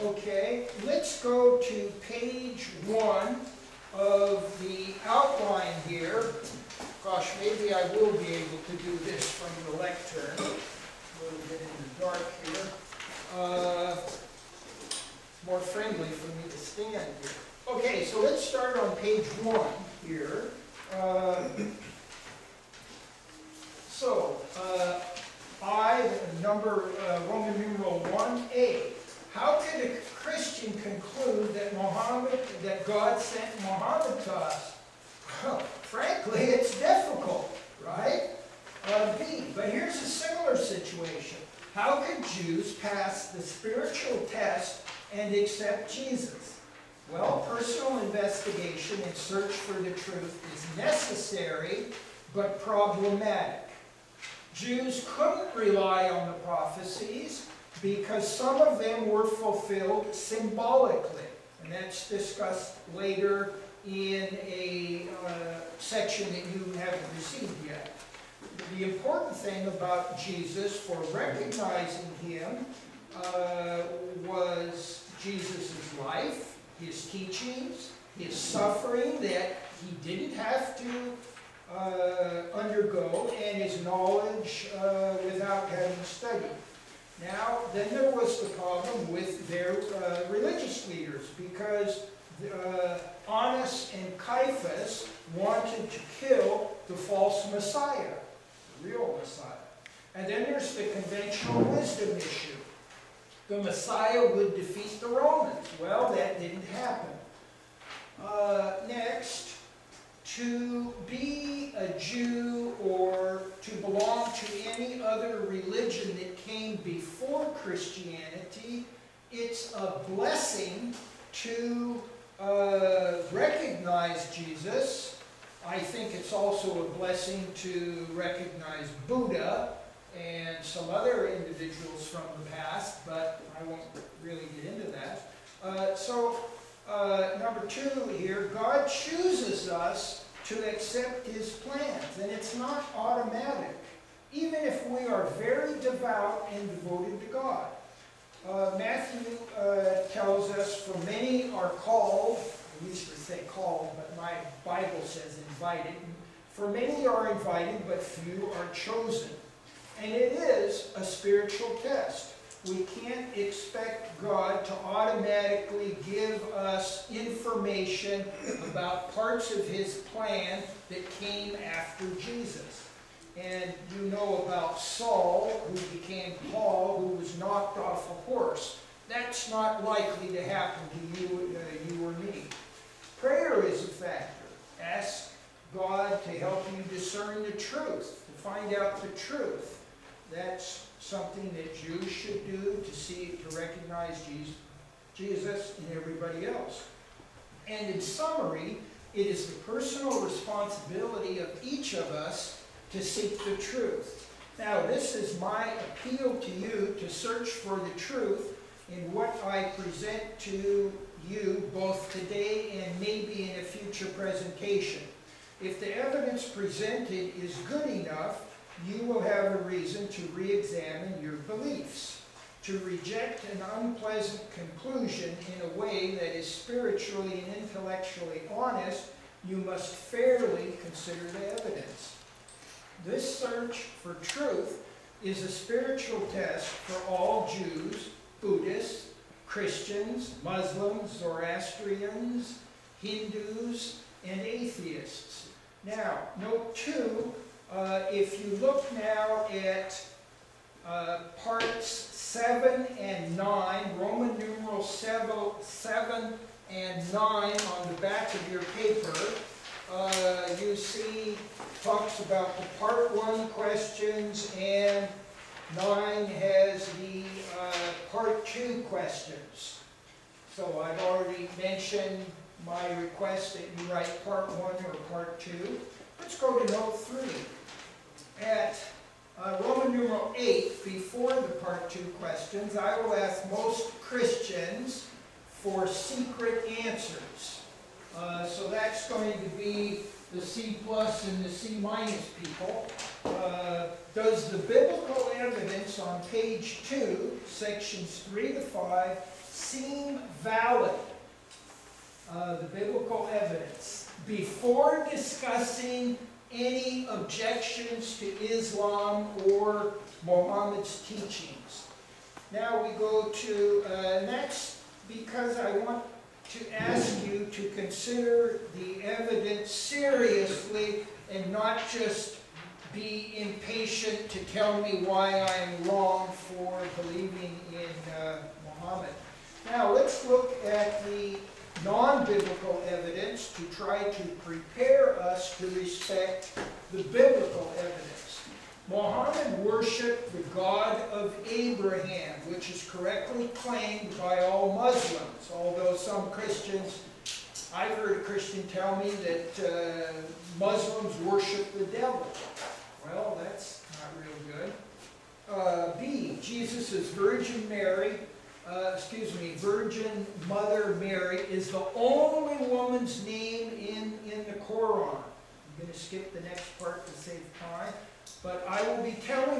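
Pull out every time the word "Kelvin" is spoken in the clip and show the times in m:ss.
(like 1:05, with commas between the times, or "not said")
not said.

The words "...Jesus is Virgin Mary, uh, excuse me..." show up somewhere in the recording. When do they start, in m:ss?
5:56.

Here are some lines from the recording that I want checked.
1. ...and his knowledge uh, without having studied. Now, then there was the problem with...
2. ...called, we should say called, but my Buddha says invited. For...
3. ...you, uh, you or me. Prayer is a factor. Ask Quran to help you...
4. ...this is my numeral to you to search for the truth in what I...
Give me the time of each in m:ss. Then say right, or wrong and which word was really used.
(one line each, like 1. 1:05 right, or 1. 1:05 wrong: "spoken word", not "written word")
1. 1:23 right
2. 2:31 wrong: "Bible", not "Buddha"
3. 3:01 wrong: "God", not "Quran"
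4. 3:24 wrong: "appeal", not "numeral".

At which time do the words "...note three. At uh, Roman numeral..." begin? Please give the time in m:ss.
4:36.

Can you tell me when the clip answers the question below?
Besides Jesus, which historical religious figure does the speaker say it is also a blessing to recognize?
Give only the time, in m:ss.
2:09.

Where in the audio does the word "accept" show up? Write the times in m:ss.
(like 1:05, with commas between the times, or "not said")
0:45, 2:20.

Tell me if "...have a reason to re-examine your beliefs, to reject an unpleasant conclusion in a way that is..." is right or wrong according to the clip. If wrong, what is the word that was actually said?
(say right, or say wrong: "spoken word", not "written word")
right.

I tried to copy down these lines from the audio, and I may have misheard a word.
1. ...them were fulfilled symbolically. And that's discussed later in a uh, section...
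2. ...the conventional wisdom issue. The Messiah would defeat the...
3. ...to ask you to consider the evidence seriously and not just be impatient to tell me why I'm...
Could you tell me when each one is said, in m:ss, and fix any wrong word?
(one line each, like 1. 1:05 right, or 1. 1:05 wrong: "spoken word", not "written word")
1. 0:58 right
2. 1:40 right
3. 5:16 right.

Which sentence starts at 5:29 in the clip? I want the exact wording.
Now let's look at the non-biblical evidence to try to prepare us to respect the biblical evidence.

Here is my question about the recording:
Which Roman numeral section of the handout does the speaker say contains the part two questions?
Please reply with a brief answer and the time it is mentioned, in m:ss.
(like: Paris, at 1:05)
9, at 4:25.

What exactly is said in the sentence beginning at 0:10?
A little bit in the dark here.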